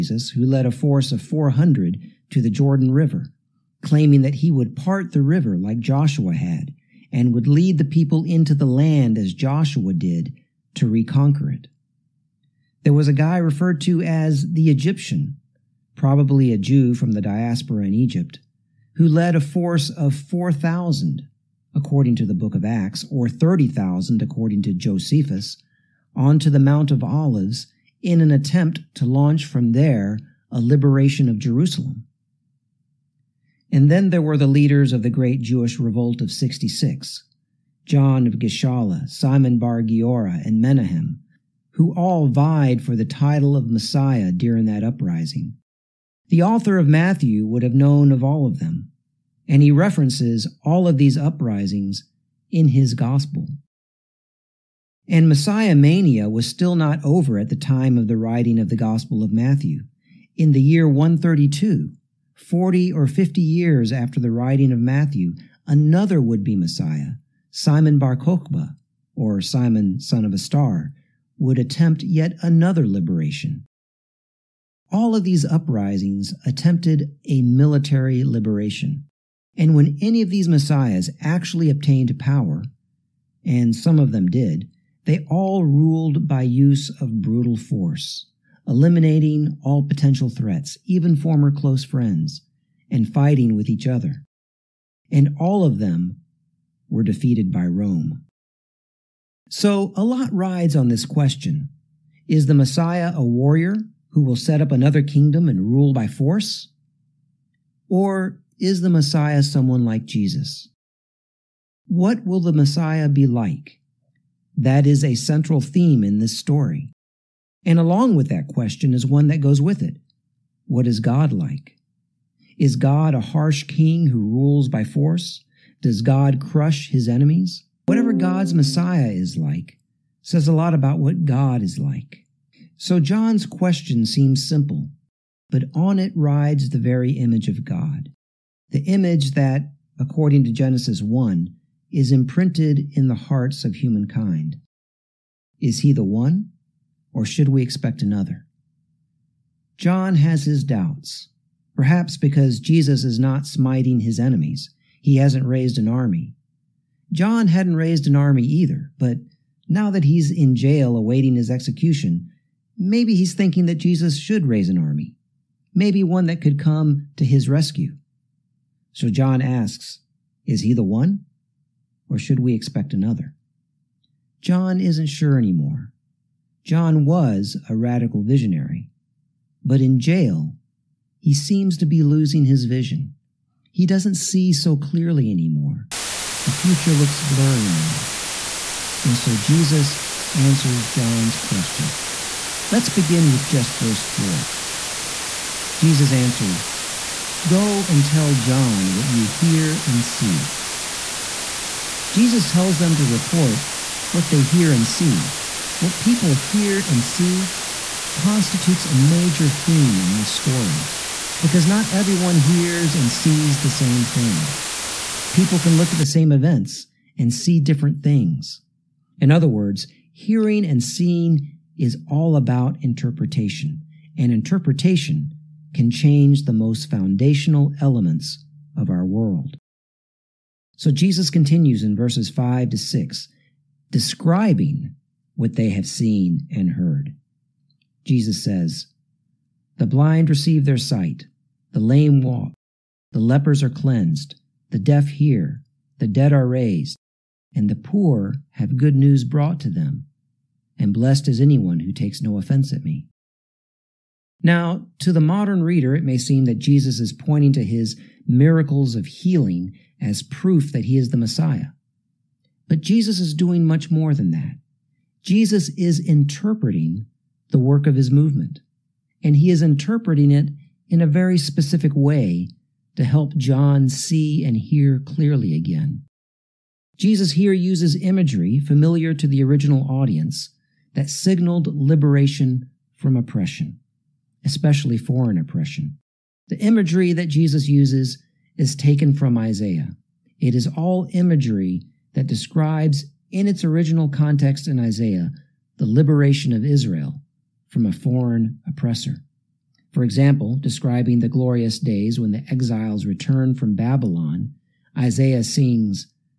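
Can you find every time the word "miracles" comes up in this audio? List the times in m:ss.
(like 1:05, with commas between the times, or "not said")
4:18.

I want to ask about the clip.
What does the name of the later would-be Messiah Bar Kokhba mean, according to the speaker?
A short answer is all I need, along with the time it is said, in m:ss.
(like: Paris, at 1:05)
son of a star, at 1:10.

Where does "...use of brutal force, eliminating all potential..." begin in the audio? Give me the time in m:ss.
1:26.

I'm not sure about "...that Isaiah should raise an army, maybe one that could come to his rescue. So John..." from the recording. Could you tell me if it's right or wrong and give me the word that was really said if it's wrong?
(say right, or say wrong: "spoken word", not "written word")
wrong: "Jesus", not "Isaiah".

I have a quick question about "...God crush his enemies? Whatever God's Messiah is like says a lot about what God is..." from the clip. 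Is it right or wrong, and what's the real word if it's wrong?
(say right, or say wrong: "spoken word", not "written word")
right.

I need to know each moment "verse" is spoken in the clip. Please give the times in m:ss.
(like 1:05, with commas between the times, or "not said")
3:13, 3:51.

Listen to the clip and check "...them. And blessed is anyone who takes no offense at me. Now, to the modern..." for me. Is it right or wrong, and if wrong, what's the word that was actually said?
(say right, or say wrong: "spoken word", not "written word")
right.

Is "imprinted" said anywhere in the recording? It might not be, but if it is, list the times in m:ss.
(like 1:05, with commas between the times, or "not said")
2:22.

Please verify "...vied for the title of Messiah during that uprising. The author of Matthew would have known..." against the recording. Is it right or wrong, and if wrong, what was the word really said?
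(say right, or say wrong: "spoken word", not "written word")
right.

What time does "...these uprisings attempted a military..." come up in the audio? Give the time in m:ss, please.
1:15.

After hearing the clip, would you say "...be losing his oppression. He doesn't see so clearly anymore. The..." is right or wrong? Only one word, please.
wrong.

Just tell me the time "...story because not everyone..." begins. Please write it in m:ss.
3:30.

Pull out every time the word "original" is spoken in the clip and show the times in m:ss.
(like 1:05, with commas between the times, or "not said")
4:39, 4:53.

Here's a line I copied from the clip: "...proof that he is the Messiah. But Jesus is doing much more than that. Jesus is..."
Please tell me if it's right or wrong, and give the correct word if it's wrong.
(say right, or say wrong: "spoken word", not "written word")
right.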